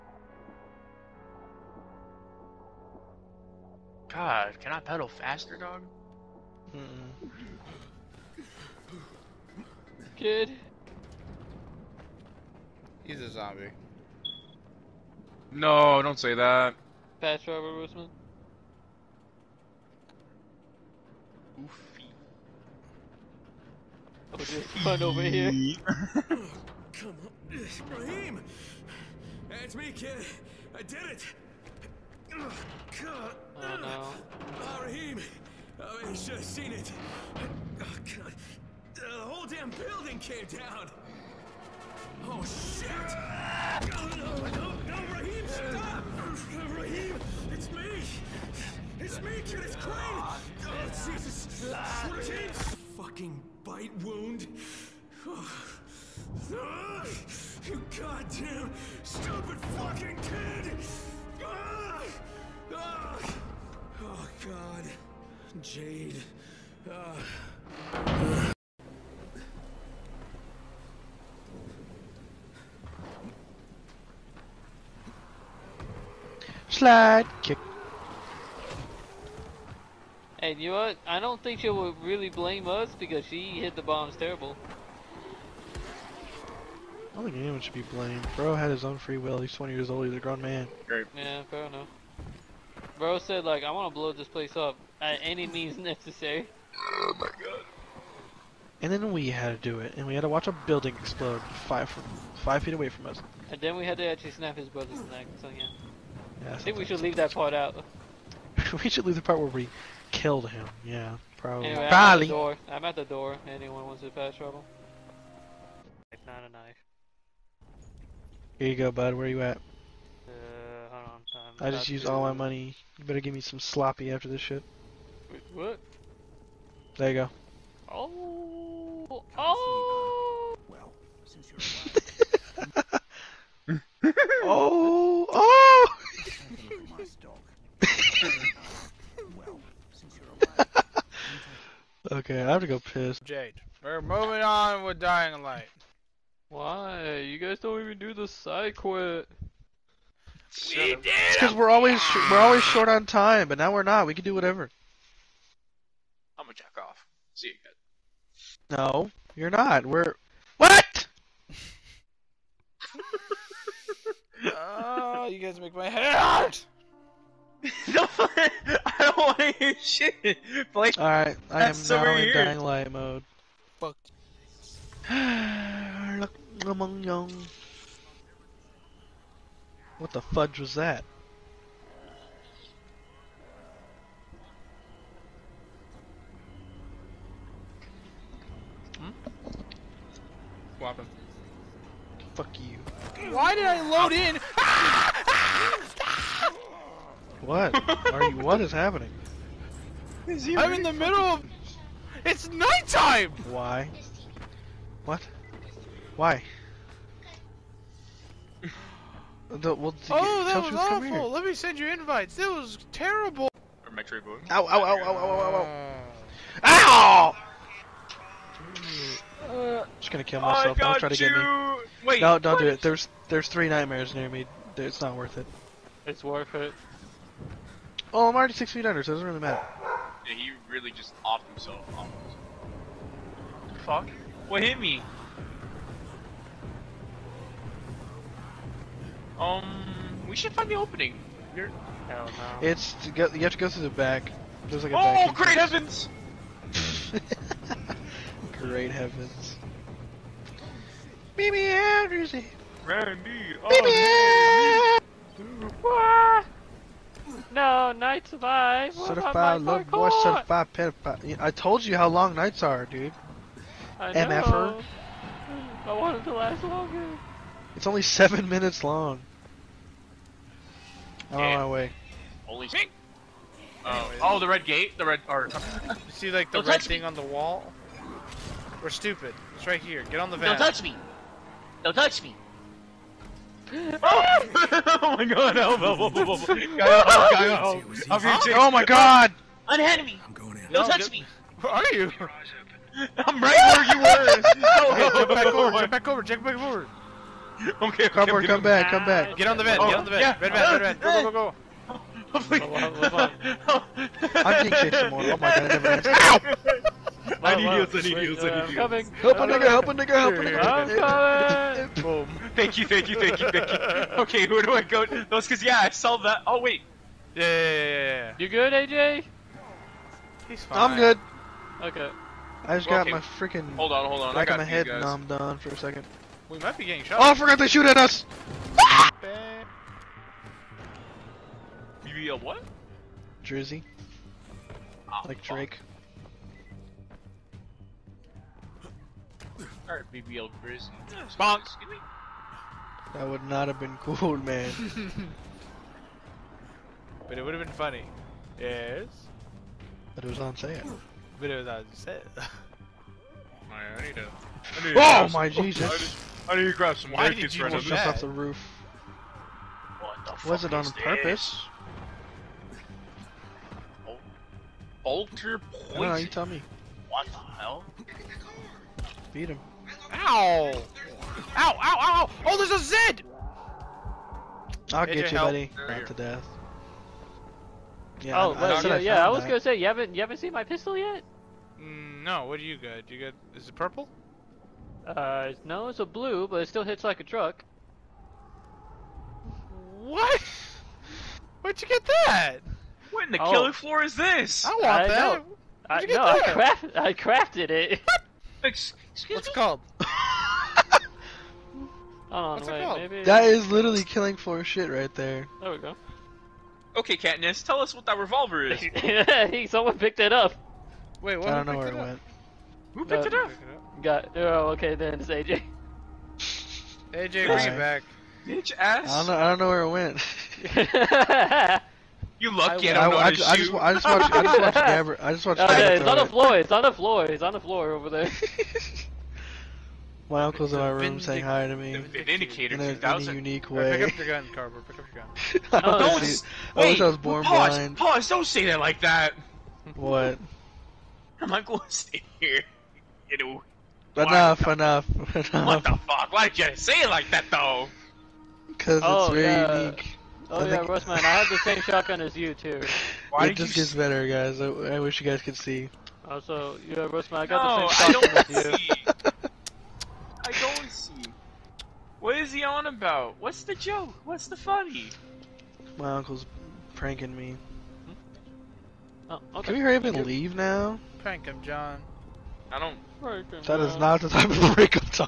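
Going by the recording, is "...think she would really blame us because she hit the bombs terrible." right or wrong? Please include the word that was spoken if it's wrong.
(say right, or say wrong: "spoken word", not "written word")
right.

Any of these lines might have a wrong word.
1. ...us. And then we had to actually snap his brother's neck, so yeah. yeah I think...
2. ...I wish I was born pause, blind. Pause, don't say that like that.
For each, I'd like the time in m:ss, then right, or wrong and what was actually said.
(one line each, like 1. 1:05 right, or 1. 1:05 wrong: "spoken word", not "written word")
1. 1:43 right
2. 7:16 right.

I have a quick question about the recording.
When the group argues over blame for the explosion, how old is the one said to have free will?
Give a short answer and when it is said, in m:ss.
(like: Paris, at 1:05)
20, at 1:29.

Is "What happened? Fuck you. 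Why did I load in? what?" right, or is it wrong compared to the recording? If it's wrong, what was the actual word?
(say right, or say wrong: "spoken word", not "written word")
right.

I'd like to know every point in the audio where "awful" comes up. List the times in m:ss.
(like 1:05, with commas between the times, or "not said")
3:30.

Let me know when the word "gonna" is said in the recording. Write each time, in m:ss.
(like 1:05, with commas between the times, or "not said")
2:36, 3:40, 6:19.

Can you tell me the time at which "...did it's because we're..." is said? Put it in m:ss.
2:30.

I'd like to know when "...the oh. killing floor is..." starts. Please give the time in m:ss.
6:33.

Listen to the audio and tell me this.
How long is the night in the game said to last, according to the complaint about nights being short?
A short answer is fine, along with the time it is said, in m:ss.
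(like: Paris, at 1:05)
seven minutes, at 4:28.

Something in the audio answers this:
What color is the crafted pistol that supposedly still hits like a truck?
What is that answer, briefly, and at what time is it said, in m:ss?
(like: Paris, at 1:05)
blue, at 6:26.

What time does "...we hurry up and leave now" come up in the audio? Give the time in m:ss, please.
7:49.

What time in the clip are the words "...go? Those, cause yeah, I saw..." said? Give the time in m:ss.
5:14.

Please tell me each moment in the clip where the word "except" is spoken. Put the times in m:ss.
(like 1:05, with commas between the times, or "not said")
not said.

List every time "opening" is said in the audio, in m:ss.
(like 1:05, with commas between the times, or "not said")
4:00.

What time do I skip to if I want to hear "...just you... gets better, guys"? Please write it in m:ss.
7:33.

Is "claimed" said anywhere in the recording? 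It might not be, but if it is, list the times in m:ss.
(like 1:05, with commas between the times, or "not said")
not said.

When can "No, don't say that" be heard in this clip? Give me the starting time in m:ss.
0:15.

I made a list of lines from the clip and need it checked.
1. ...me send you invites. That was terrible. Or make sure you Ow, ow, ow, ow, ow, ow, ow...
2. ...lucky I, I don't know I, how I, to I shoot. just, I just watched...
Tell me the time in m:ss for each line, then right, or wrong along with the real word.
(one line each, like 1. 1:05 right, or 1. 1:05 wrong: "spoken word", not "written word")
1. 3:31 right
2. 7:02 right.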